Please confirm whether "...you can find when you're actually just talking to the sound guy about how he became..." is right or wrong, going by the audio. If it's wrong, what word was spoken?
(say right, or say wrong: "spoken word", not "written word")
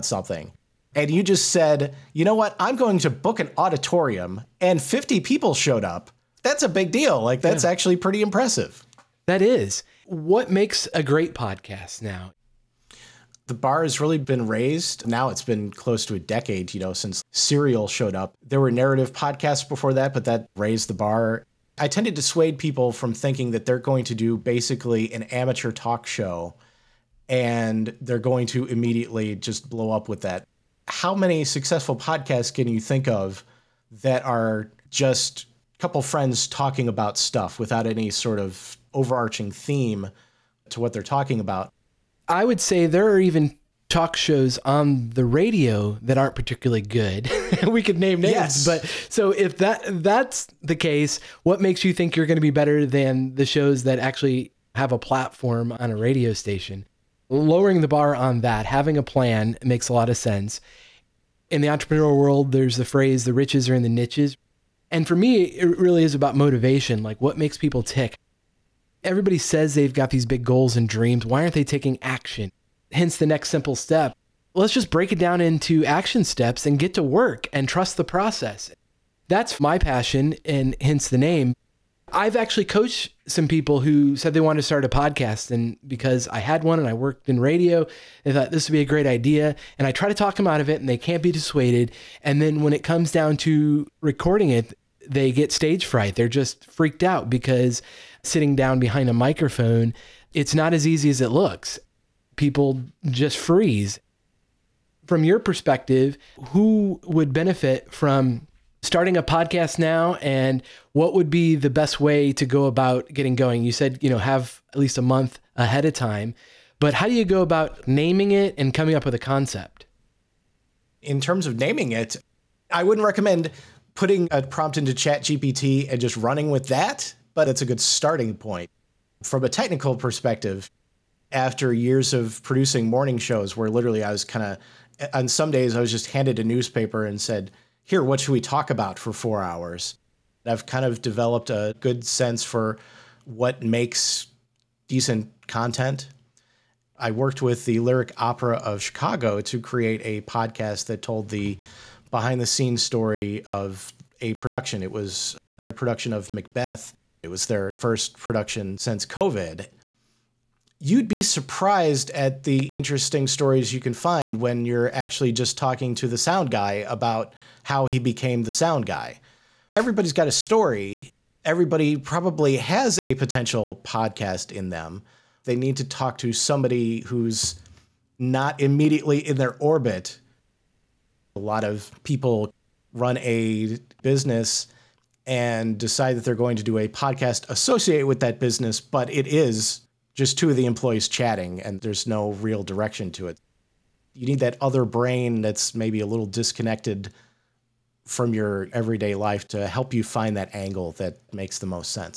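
right.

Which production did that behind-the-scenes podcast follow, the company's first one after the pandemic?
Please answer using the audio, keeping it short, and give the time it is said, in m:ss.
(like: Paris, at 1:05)
Macbeth, at 2:36.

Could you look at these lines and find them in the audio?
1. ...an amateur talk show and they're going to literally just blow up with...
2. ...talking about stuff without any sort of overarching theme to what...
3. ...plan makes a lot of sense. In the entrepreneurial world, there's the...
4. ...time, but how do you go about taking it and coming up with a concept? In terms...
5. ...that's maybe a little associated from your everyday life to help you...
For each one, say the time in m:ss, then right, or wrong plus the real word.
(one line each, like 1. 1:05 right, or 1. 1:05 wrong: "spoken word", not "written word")
1. 0:25 wrong: "immediately", not "literally"
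2. 0:36 right
3. 0:59 right
4. 1:55 wrong: "naming", not "taking"
5. 3:15 wrong: "disconnected", not "associated".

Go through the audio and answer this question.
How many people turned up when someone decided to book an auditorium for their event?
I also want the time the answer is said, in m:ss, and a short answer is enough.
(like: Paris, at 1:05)
50, at 0:04.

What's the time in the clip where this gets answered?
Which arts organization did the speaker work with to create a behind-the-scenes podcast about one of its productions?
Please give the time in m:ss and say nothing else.
2:27.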